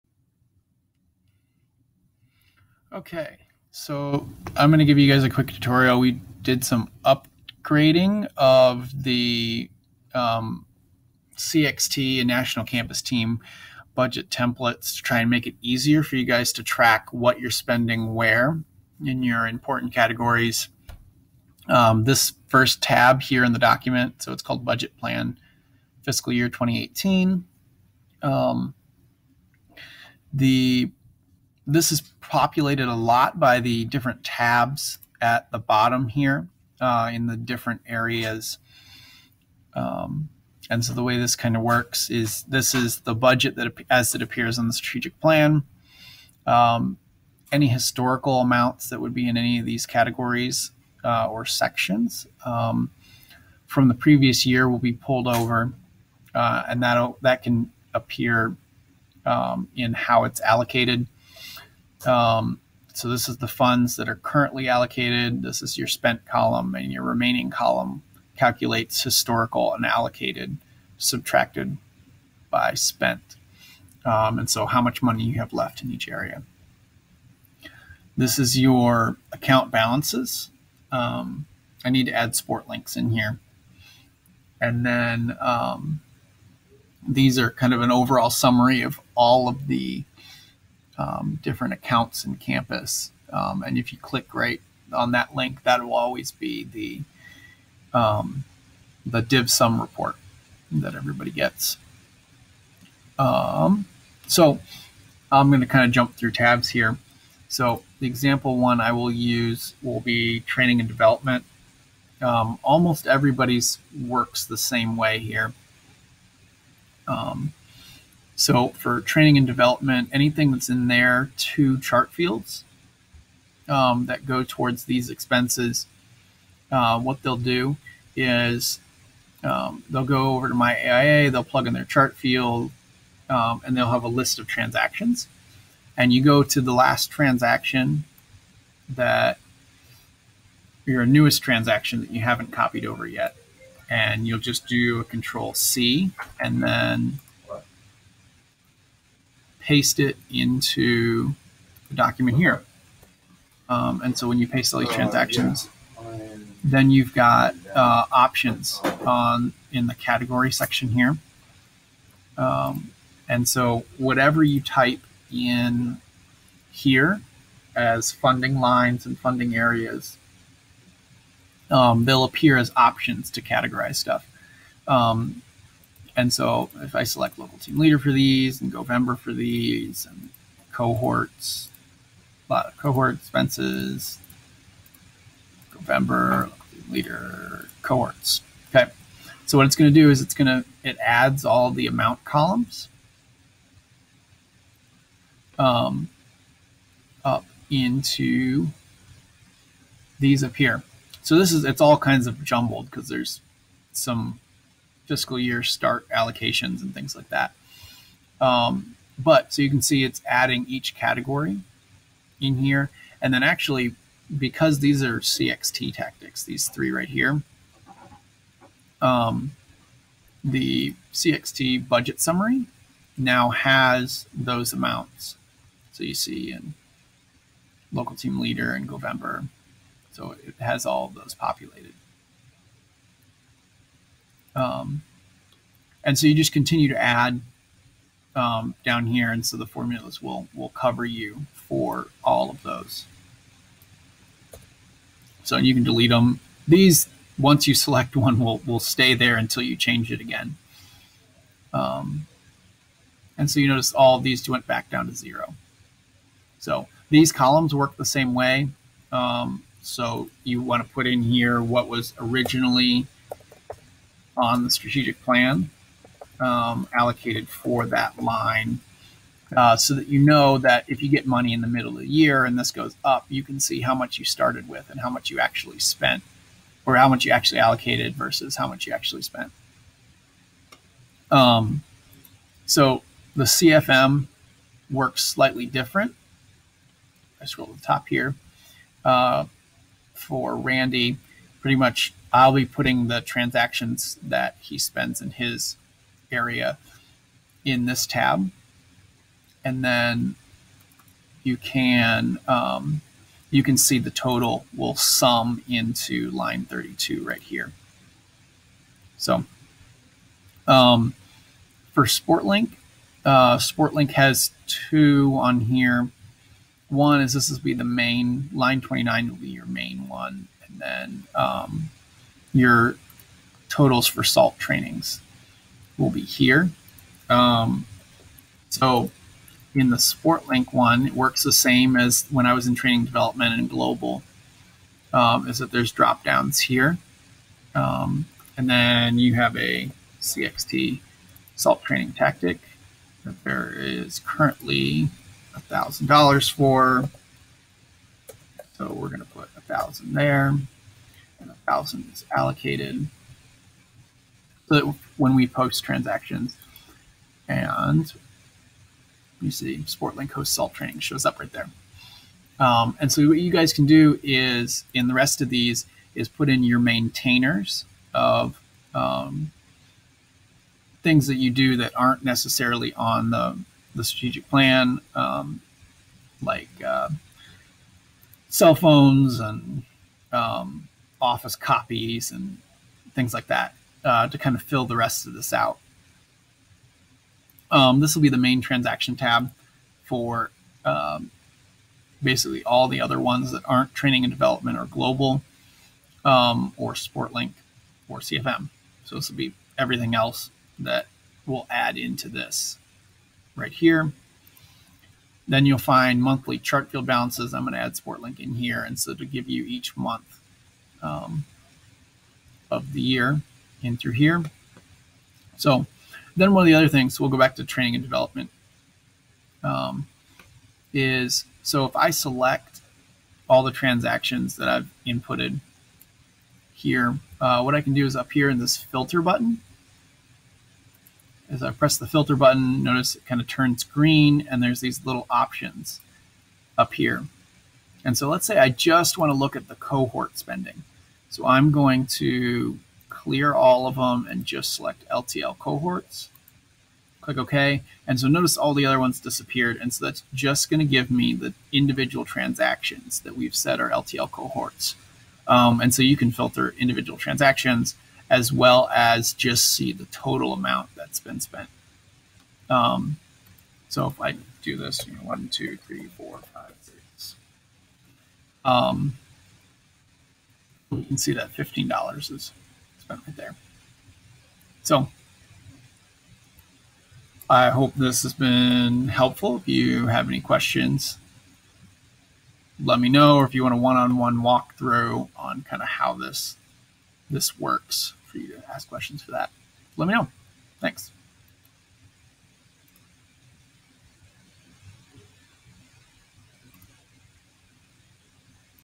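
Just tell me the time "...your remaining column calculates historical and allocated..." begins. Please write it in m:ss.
1:06.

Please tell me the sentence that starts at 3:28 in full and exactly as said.
Um, but so you can see it's adding each category in here.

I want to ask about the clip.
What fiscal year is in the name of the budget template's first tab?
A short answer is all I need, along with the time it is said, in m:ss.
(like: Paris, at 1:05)
2018, at 0:26.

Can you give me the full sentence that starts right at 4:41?
Um, so the CFM works slightly different.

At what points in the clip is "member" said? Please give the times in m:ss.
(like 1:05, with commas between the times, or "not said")
2:58, 3:05.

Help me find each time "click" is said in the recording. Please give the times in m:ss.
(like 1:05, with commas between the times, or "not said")
1:33, 7:27.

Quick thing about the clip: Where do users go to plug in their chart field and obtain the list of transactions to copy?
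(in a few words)
My AIA.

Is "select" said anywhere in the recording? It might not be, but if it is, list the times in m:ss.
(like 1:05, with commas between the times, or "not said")
2:57, 4:07, 7:02, 7:24.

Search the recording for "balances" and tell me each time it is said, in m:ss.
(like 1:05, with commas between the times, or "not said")
1:19, 6:47.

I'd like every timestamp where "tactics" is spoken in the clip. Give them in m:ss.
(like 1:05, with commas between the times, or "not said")
3:35, 5:42.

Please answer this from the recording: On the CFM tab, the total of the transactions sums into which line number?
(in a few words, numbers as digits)
32.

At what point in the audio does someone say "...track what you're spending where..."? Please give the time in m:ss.
0:16.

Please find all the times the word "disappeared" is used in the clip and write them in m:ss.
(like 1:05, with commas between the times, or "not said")
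7:29.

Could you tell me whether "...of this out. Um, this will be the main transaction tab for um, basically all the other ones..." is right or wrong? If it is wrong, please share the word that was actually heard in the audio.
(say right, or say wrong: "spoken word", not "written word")
right.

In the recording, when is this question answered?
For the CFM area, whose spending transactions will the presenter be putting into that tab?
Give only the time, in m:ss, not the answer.
4:50.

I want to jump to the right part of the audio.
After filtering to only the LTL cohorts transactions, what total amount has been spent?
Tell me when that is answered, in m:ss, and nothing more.
7:51.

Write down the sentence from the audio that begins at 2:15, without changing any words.
And you go to the last transaction that your newest transaction that you haven't copied over yet.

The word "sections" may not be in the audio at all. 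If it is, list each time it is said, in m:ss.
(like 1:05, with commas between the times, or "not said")
0:51, 2:40.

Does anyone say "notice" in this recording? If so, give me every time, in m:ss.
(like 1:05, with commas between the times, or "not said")
4:13, 7:12, 7:28.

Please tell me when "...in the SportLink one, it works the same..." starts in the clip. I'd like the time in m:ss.
5:29.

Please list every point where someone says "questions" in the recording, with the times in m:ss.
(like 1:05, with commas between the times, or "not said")
8:00, 8:08.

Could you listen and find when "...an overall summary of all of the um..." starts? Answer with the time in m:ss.
1:27.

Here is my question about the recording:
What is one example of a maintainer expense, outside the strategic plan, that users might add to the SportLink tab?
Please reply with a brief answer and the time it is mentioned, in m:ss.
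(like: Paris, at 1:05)
Cell phones, at 6:18.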